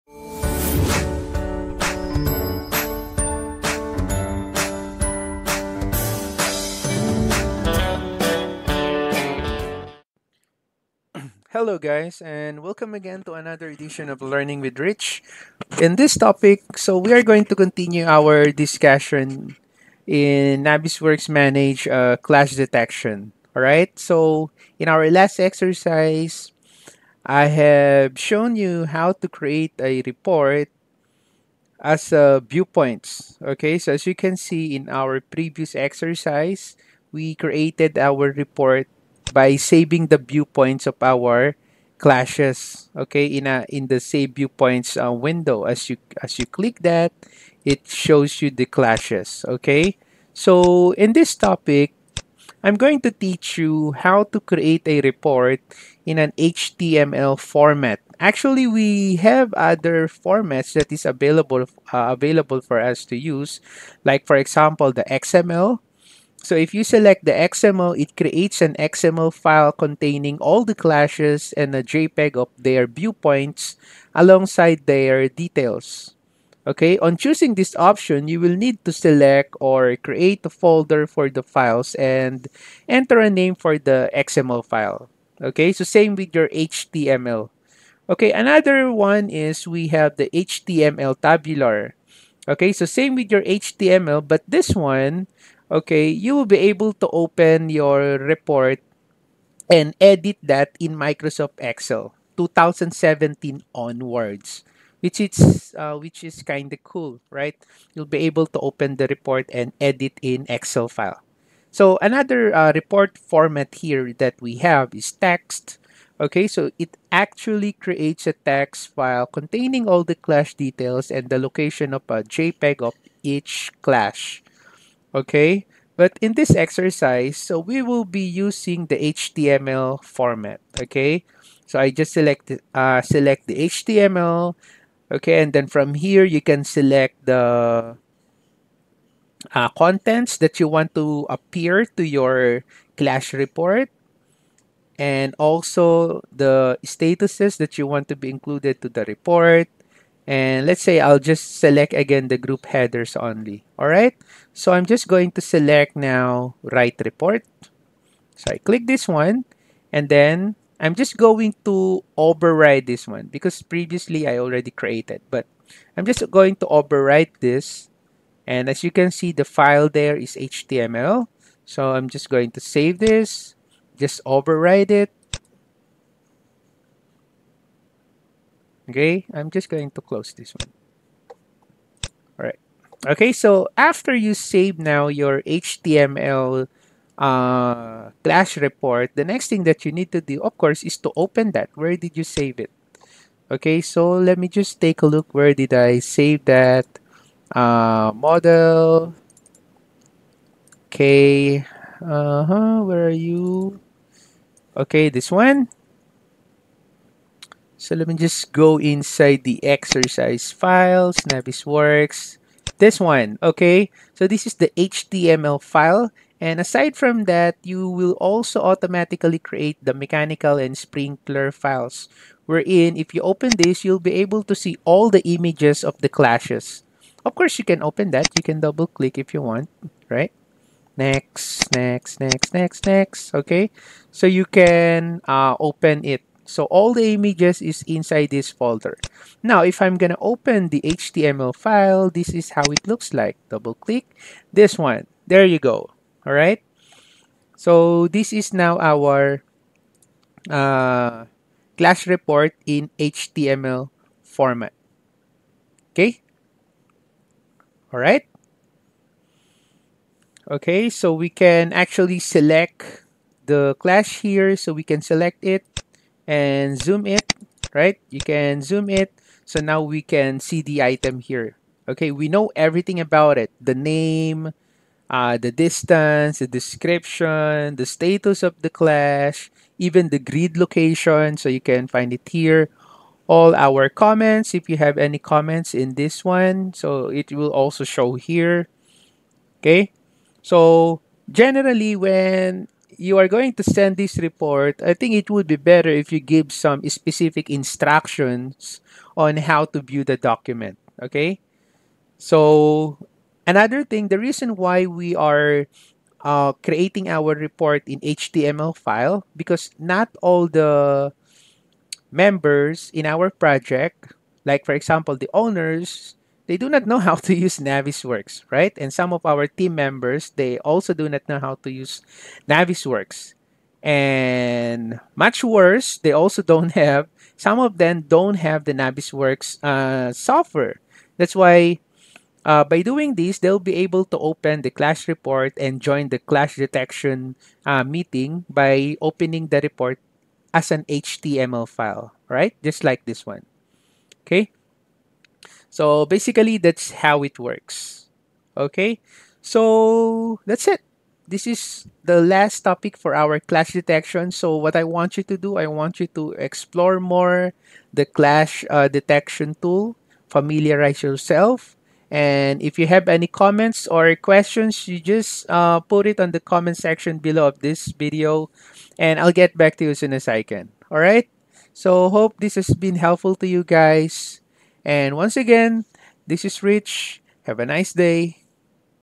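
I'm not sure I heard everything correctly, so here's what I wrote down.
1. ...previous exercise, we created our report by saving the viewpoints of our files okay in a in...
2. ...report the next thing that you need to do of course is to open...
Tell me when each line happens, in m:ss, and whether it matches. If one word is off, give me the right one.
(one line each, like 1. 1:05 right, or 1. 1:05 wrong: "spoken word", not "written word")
1. 0:35 wrong: "clashes", not "files"
2. 3:08 right.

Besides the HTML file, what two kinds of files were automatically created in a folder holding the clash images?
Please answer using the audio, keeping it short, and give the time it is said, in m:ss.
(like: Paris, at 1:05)
Mechanical and sprinkler, at 3:39.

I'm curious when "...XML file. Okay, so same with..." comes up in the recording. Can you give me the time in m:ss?
1:24.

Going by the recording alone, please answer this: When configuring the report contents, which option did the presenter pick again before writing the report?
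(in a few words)
Group headers only.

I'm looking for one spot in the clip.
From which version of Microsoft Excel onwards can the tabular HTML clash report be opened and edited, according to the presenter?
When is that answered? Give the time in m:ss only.
1:42.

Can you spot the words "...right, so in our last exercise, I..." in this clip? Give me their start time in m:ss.
0:23.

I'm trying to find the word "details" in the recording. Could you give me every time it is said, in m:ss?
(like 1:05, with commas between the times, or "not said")
1:15, 2:00.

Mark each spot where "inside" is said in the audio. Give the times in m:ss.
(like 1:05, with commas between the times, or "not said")
3:28, 3:57.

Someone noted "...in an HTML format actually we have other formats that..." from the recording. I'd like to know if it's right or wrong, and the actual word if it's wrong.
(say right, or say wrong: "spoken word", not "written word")
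right.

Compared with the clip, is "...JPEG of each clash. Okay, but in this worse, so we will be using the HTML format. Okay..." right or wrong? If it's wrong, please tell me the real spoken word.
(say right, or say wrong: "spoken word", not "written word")
wrong: "exercise", not "worse".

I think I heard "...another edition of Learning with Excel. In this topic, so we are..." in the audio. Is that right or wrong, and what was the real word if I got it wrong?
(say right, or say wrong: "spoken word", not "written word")
wrong: "Rich", not "Excel".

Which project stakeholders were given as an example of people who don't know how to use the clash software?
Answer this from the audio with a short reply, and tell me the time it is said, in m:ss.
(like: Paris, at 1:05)
The owners, at 5:15.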